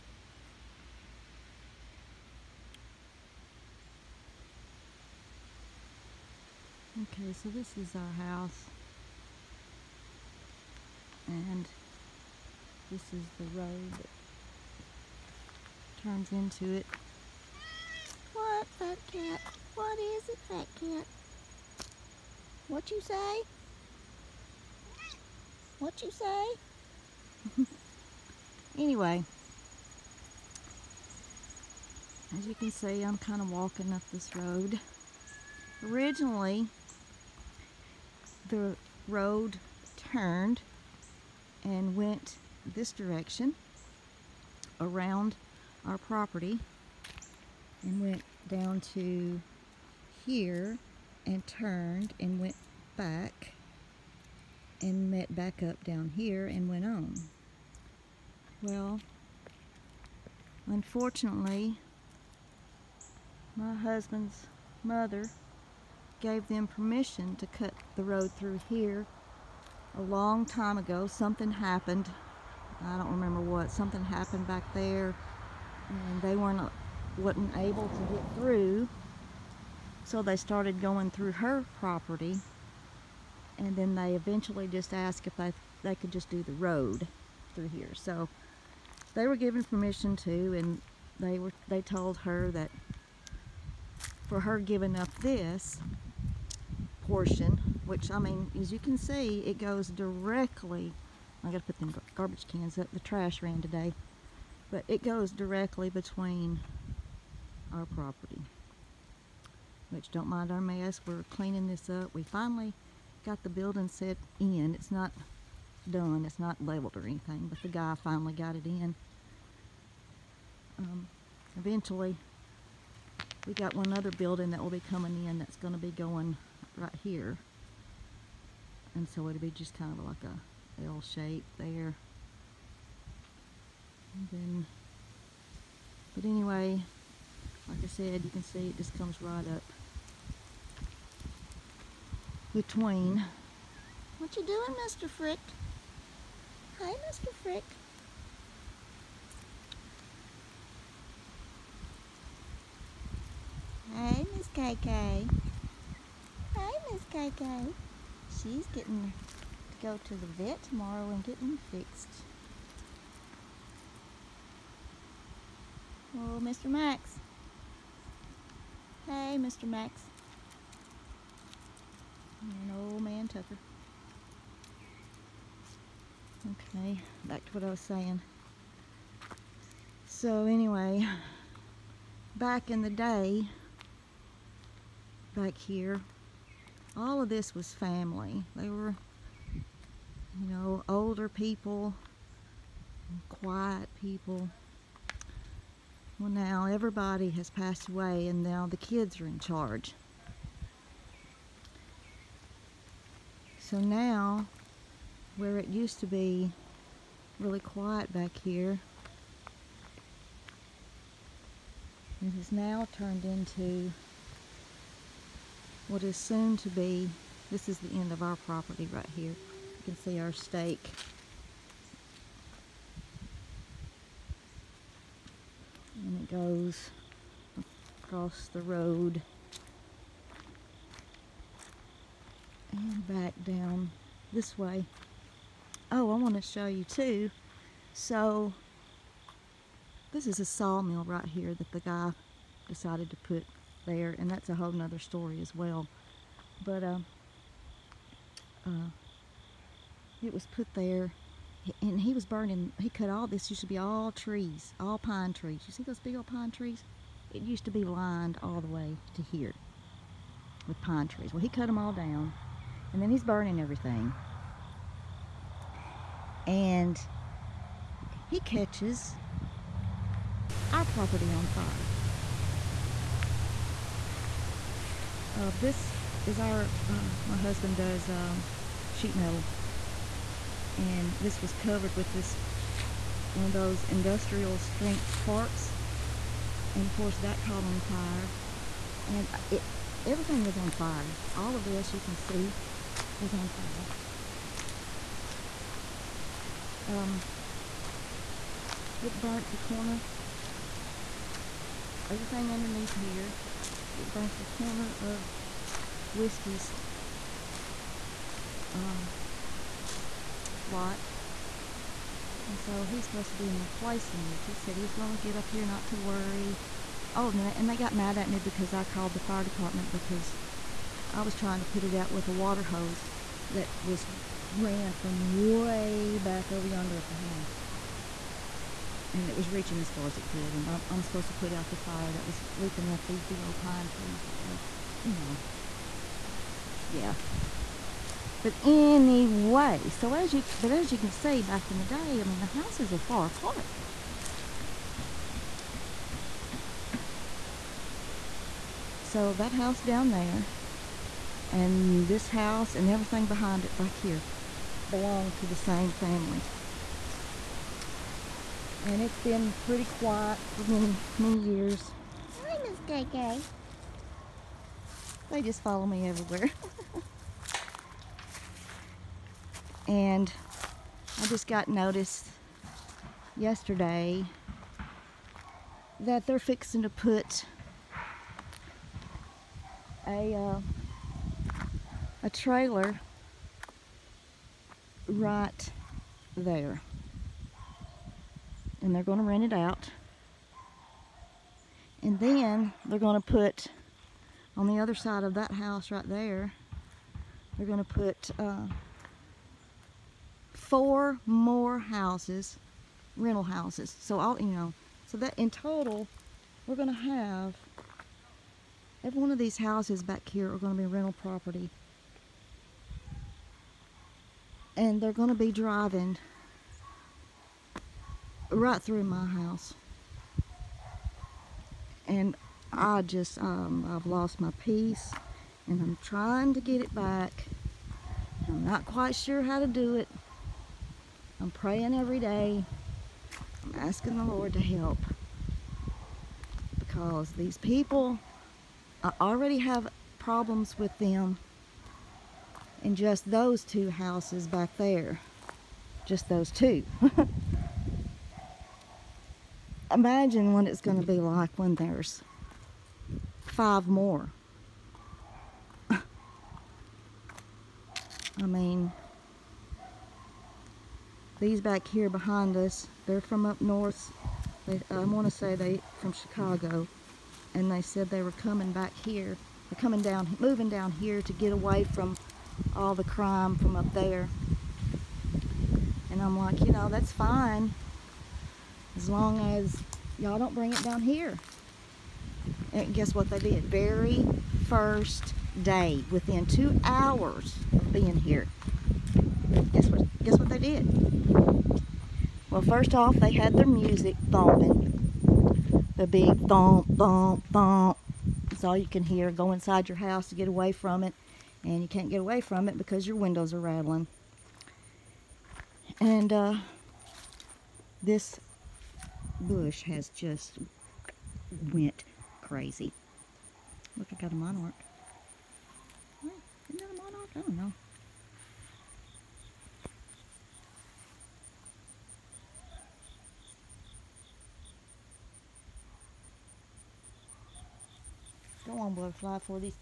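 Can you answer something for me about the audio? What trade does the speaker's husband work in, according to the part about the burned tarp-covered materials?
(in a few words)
Sheet metal.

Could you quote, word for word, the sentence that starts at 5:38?
But anyway, so as you but as you can see back in the day, I mean the houses are far apart.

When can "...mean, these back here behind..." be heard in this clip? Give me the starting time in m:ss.
7:38.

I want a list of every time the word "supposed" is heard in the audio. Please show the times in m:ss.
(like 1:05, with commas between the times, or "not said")
5:13, 5:31.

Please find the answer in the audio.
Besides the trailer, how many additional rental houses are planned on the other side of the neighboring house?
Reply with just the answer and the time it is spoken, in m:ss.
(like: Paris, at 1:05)
4, at 6:40.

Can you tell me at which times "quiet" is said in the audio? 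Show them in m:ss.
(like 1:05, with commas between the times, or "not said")
3:13, 3:27, 5:59.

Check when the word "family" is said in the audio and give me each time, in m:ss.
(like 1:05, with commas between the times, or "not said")
3:07, 5:55.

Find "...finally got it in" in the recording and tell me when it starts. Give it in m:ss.
1:58.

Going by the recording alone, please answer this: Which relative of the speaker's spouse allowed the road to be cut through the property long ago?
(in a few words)
Husband's mother.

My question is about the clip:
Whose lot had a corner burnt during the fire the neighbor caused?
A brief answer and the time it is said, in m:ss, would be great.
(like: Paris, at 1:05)
Whiskey's, at 5:06.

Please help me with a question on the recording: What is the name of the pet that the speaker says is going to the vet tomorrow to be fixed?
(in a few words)
Coco.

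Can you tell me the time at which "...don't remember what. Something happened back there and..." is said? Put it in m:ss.
1:12.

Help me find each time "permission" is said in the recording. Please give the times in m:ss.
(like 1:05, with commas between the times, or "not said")
1:06, 1:29.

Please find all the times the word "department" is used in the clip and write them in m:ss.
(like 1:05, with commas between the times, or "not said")
5:19.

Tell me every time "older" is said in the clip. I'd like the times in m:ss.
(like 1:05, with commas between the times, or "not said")
3:10.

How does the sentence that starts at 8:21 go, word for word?
And you can't get away from it because your windows are rattling.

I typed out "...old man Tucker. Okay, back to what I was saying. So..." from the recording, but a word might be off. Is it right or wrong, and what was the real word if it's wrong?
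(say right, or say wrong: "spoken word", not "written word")
right.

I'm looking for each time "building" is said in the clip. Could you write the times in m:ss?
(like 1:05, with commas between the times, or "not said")
1:53, 2:04.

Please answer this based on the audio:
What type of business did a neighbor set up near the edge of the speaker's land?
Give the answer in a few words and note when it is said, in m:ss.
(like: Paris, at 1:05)
Sawmill, at 4:00.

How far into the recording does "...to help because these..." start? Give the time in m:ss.
7:14.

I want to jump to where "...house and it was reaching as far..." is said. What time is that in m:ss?
5:27.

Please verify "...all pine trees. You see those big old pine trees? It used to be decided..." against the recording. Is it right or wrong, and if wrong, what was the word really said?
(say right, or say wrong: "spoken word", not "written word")
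wrong: "lined", not "decided".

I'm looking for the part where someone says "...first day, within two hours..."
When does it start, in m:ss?
8:04.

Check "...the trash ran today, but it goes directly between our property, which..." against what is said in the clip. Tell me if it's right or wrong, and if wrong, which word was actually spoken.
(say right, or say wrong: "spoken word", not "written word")
right.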